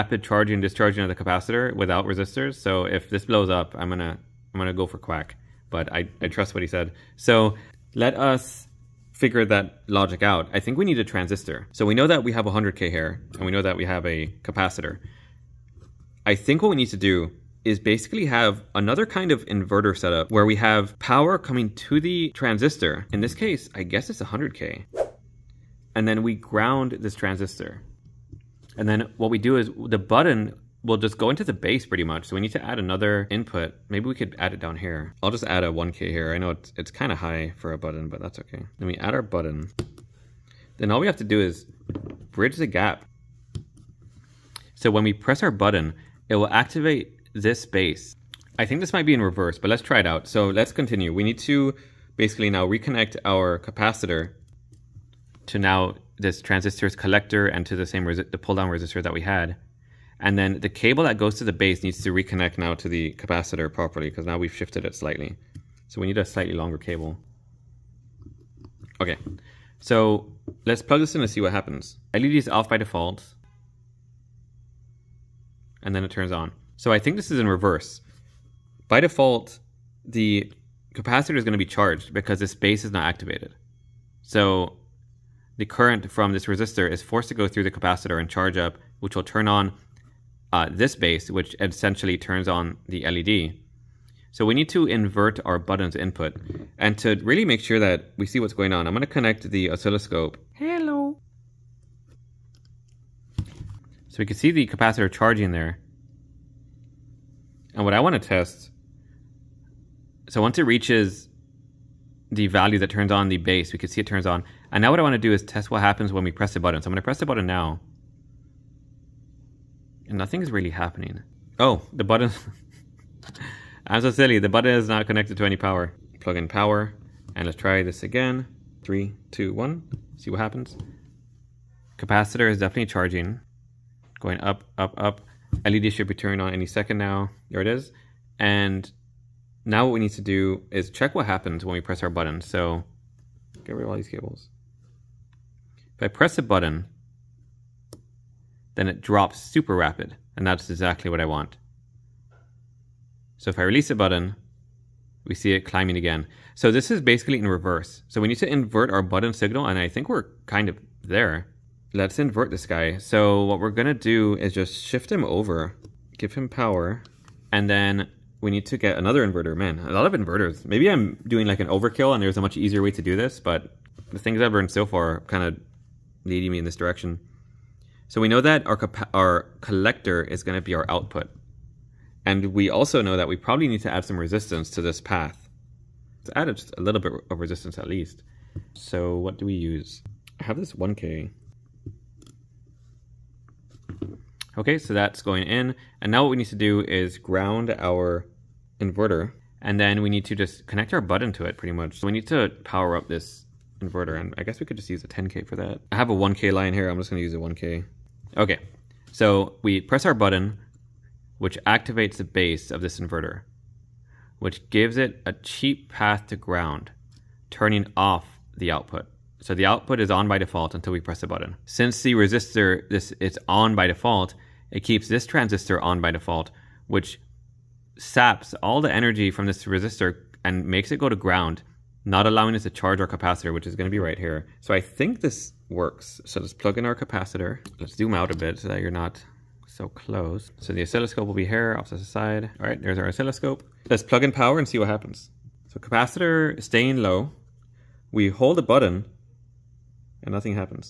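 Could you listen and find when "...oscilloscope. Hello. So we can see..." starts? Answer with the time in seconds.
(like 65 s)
99 s.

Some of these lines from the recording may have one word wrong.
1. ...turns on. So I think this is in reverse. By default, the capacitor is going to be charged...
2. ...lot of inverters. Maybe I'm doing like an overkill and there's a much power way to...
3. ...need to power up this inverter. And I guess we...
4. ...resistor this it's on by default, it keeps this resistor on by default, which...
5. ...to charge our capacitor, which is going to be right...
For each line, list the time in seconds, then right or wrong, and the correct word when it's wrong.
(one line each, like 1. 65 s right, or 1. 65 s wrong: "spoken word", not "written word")
1. 76 s right
2. 169 s wrong: "easier", not "power"
3. 202 s right
4. 222 s wrong: "transistor", not "resistor"
5. 232 s right.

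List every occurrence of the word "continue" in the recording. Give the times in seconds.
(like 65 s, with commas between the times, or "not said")
50 s.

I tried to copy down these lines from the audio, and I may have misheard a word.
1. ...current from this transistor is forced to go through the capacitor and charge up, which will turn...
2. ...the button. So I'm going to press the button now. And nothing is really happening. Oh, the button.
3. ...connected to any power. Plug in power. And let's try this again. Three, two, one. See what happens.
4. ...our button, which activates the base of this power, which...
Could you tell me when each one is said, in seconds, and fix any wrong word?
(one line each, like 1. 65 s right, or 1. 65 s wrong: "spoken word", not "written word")
1. 85 s wrong: "resistor", not "transistor"
2. 116 s right
3. 125 s right
4. 210 s wrong: "inverter", not "power".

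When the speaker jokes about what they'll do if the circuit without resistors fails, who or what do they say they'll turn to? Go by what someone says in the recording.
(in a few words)
Quack.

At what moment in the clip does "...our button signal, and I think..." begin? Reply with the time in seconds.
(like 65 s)
158 s.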